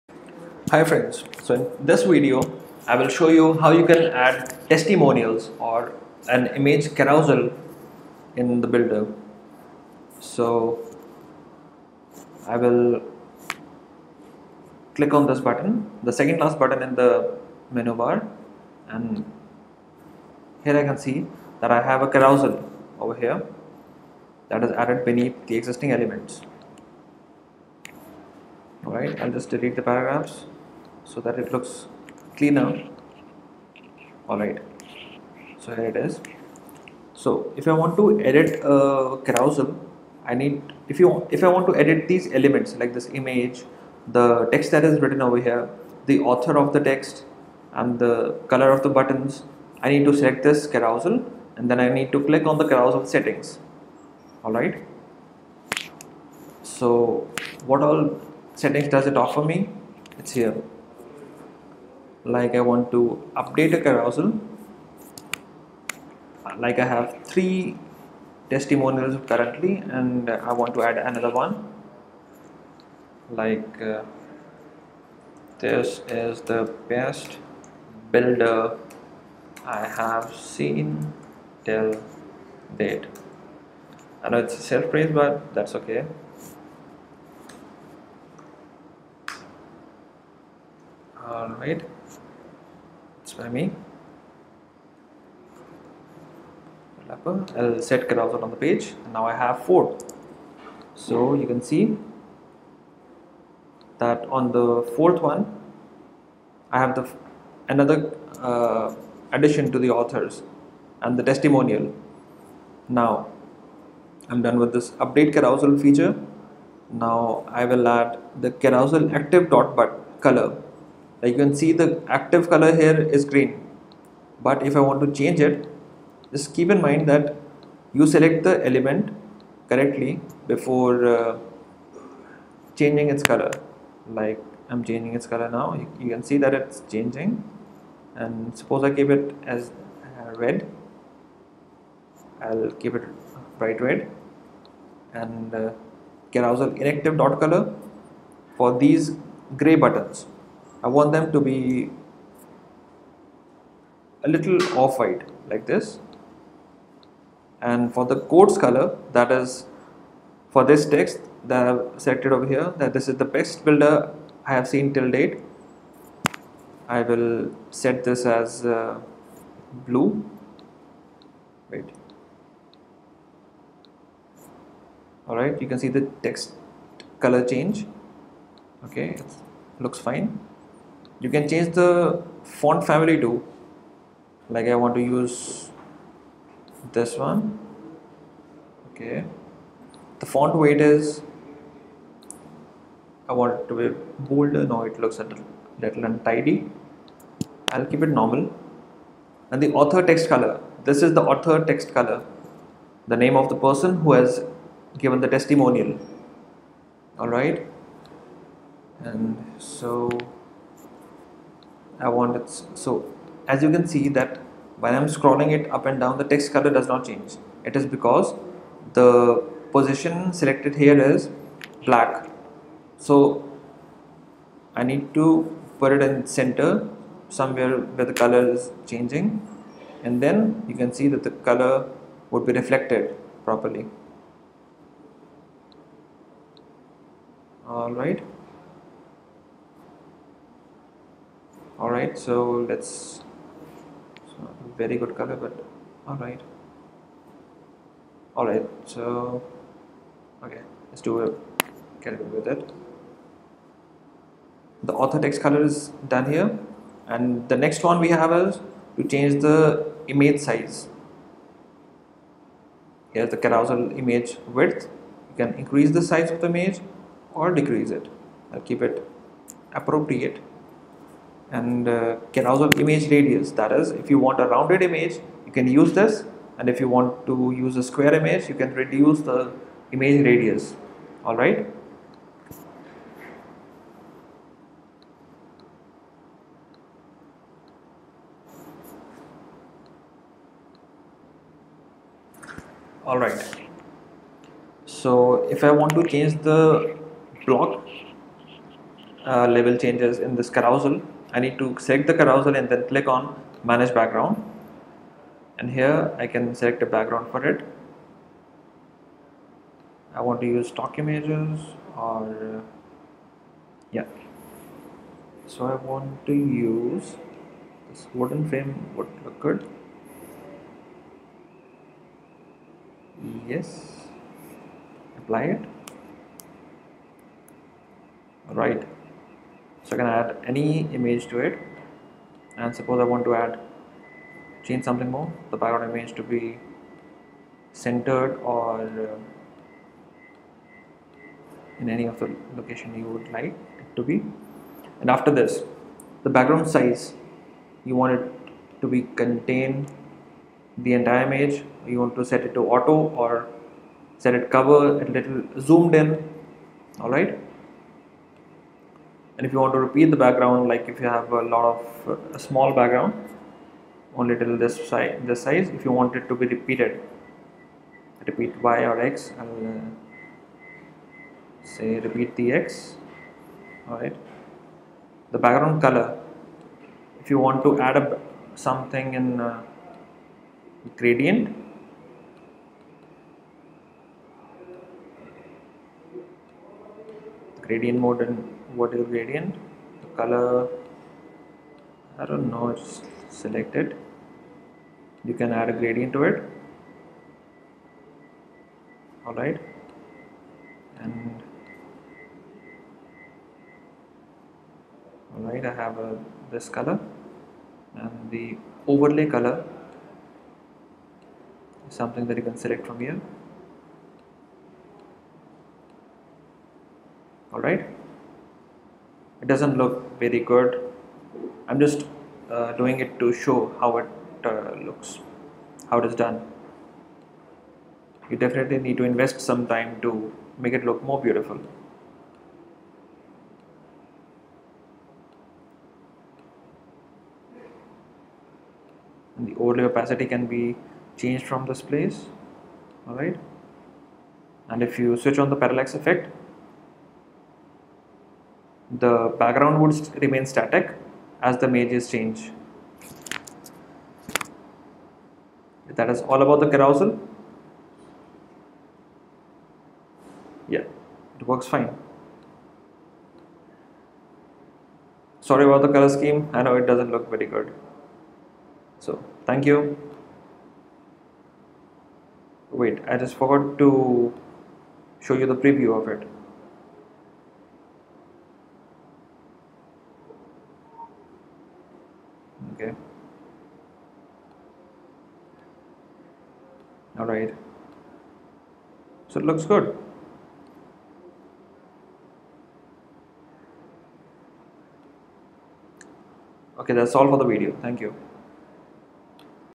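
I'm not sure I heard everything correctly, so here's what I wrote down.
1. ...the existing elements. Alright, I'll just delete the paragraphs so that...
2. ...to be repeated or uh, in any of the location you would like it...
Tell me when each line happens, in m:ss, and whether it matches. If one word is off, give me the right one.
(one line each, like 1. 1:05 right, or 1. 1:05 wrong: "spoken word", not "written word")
1. 0:25 right
2. 5:36 wrong: "centered", not "repeated".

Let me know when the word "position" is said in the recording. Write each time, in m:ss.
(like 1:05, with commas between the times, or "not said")
3:39.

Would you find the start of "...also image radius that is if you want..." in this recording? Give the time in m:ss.
4:32.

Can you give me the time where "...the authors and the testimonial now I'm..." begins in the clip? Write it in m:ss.
1:49.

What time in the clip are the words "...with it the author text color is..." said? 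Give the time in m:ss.
4:12.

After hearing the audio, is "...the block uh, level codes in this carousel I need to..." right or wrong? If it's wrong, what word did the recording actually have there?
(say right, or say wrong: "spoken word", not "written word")
wrong: "changes", not "codes".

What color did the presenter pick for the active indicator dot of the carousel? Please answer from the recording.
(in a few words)
bright red.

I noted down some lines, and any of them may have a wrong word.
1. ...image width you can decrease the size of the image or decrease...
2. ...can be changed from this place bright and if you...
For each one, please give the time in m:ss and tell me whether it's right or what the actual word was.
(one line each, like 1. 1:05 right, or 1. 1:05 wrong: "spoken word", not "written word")
1. 4:24 wrong: "increase", not "decrease"
2. 7:20 wrong: "alright", not "bright".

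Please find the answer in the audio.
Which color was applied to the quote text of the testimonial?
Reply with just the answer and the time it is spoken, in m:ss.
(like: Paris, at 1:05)
blue, at 2:49.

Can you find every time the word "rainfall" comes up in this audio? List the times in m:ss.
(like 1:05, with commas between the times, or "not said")
not said.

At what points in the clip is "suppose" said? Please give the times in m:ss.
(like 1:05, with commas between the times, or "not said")
2:18, 5:32.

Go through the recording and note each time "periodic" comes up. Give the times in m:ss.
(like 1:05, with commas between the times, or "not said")
not said.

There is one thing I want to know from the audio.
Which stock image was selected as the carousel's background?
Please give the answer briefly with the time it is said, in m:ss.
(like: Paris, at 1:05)
wooden frame, at 5:18.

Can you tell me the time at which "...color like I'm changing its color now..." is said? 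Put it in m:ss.
2:13.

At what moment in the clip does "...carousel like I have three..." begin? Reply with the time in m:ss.
1:03.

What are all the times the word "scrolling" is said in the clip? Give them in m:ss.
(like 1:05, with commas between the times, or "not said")
3:35.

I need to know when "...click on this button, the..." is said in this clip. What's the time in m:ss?
0:14.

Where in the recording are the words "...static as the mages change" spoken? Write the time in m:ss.
7:30.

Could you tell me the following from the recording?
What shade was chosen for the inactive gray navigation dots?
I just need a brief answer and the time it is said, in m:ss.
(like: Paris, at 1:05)
off-white, at 2:34.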